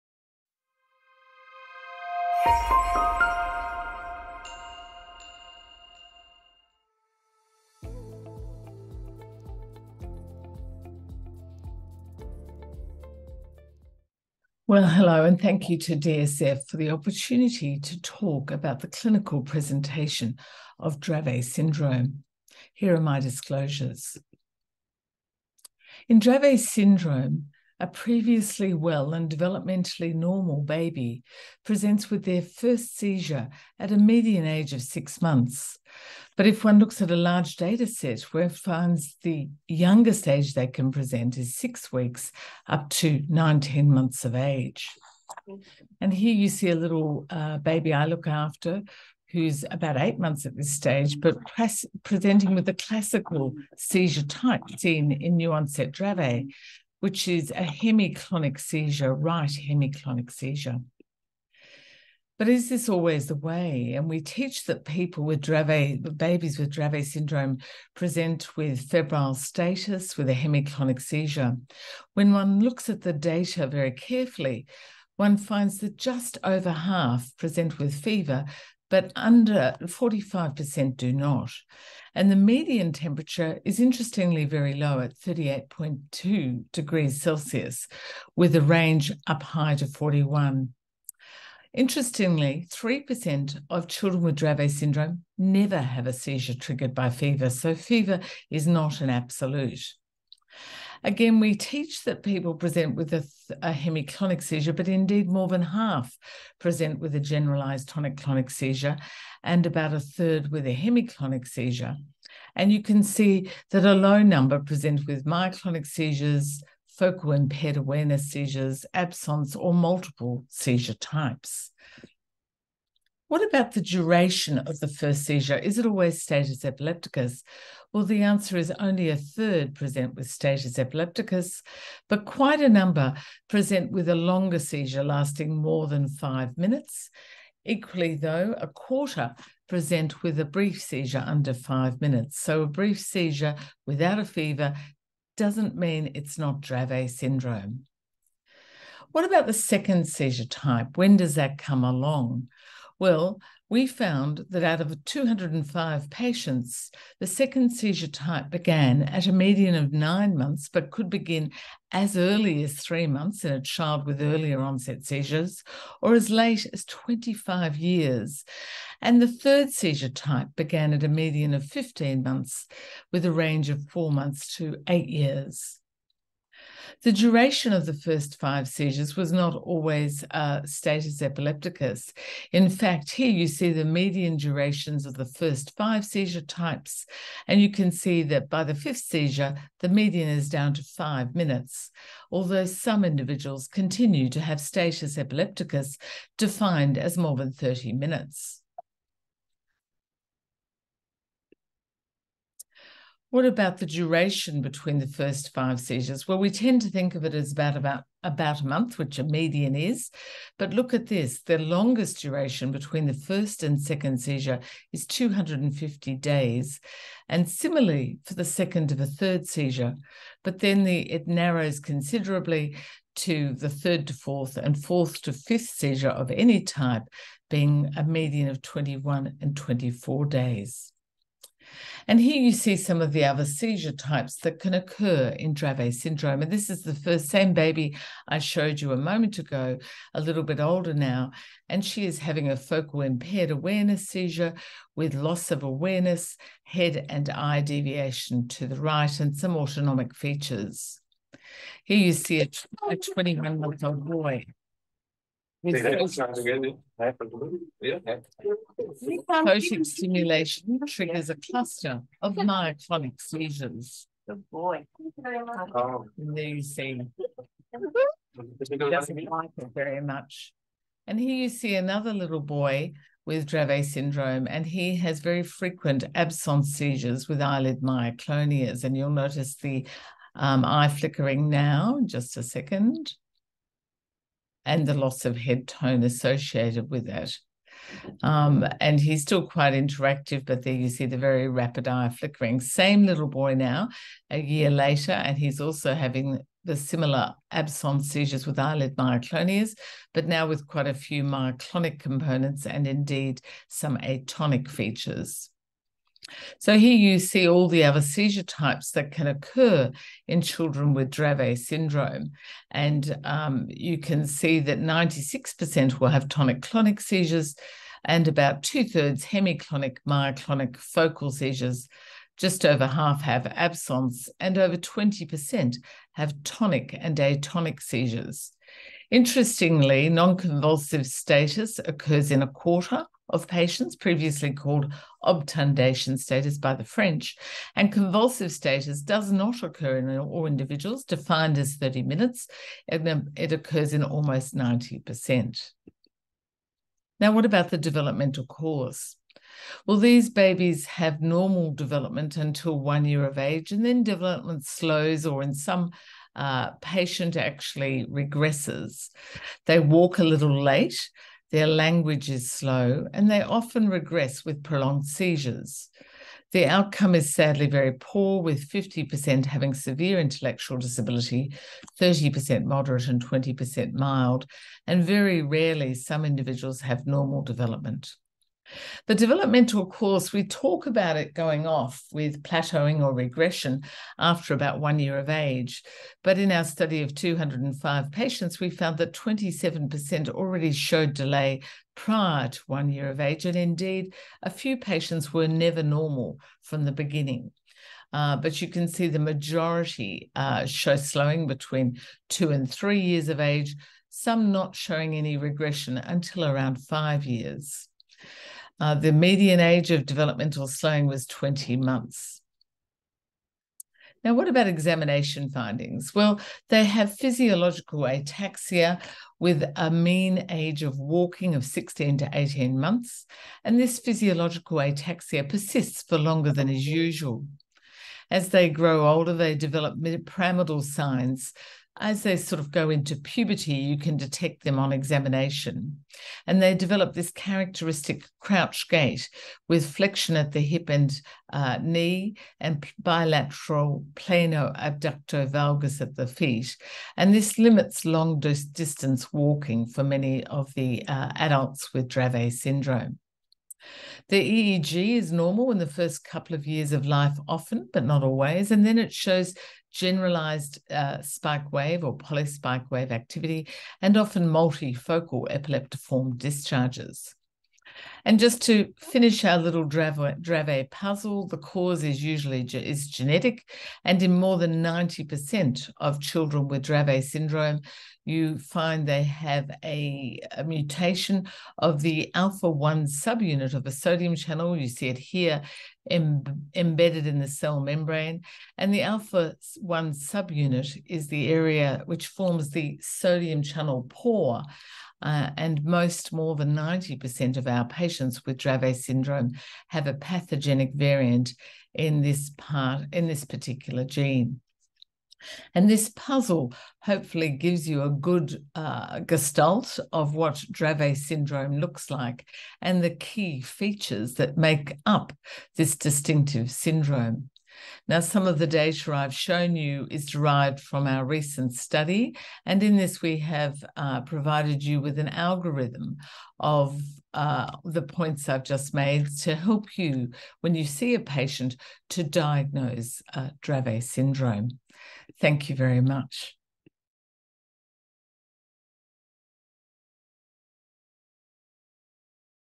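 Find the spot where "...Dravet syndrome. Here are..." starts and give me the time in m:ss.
0:20.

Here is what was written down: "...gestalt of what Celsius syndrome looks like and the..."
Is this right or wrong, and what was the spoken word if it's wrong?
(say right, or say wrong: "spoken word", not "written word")
wrong: "Dravet", not "Celsius".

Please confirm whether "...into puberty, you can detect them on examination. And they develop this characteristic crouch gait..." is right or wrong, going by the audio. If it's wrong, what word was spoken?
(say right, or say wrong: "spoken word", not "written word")
right.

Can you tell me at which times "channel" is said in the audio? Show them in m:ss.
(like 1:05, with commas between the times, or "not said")
8:04, 8:13.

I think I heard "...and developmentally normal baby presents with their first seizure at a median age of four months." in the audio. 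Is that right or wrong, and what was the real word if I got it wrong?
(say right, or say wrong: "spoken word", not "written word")
wrong: "six", not "four".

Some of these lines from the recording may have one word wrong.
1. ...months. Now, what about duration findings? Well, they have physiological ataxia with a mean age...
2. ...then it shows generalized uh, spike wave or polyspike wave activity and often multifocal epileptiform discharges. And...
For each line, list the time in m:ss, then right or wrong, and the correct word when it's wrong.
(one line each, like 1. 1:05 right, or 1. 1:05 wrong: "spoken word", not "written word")
1. 6:51 wrong: "examination", not "duration"
2. 7:38 right.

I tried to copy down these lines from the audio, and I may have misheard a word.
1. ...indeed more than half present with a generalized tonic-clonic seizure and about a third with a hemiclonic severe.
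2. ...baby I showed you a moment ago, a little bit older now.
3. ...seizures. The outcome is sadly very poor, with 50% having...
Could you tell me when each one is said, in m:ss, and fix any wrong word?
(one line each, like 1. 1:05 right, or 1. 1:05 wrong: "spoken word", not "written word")
1. 1:44 wrong: "seizure", not "severe"
2. 3:57 right
3. 6:05 right.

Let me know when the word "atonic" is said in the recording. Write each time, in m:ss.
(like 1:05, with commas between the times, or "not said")
5:03, 5:27.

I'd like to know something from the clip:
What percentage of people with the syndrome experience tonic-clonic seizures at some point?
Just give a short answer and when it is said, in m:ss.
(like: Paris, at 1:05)
96%, at 5:14.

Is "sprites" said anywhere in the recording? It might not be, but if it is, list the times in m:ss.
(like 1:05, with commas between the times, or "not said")
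not said.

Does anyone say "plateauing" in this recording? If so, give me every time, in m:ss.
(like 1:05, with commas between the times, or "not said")
6:22.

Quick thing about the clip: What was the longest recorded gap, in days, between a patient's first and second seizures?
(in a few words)
250 days.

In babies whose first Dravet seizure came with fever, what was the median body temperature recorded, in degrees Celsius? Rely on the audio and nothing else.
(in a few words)
38.2.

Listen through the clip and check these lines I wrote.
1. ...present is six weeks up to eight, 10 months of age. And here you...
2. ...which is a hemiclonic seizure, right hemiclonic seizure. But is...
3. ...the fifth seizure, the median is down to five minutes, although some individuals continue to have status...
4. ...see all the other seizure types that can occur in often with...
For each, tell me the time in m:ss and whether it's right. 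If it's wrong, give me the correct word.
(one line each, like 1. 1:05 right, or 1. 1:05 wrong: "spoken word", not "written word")
1. 0:40 wrong: "nine", not "eight"
2. 0:57 right
3. 3:08 right
4. 5:07 wrong: "children", not "often".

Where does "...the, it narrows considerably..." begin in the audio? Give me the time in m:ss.
3:40.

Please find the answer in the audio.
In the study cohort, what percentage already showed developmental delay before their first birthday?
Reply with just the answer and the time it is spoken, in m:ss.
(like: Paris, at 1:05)
27%, at 6:29.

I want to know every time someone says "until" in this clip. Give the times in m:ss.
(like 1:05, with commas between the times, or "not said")
5:52, 6:45.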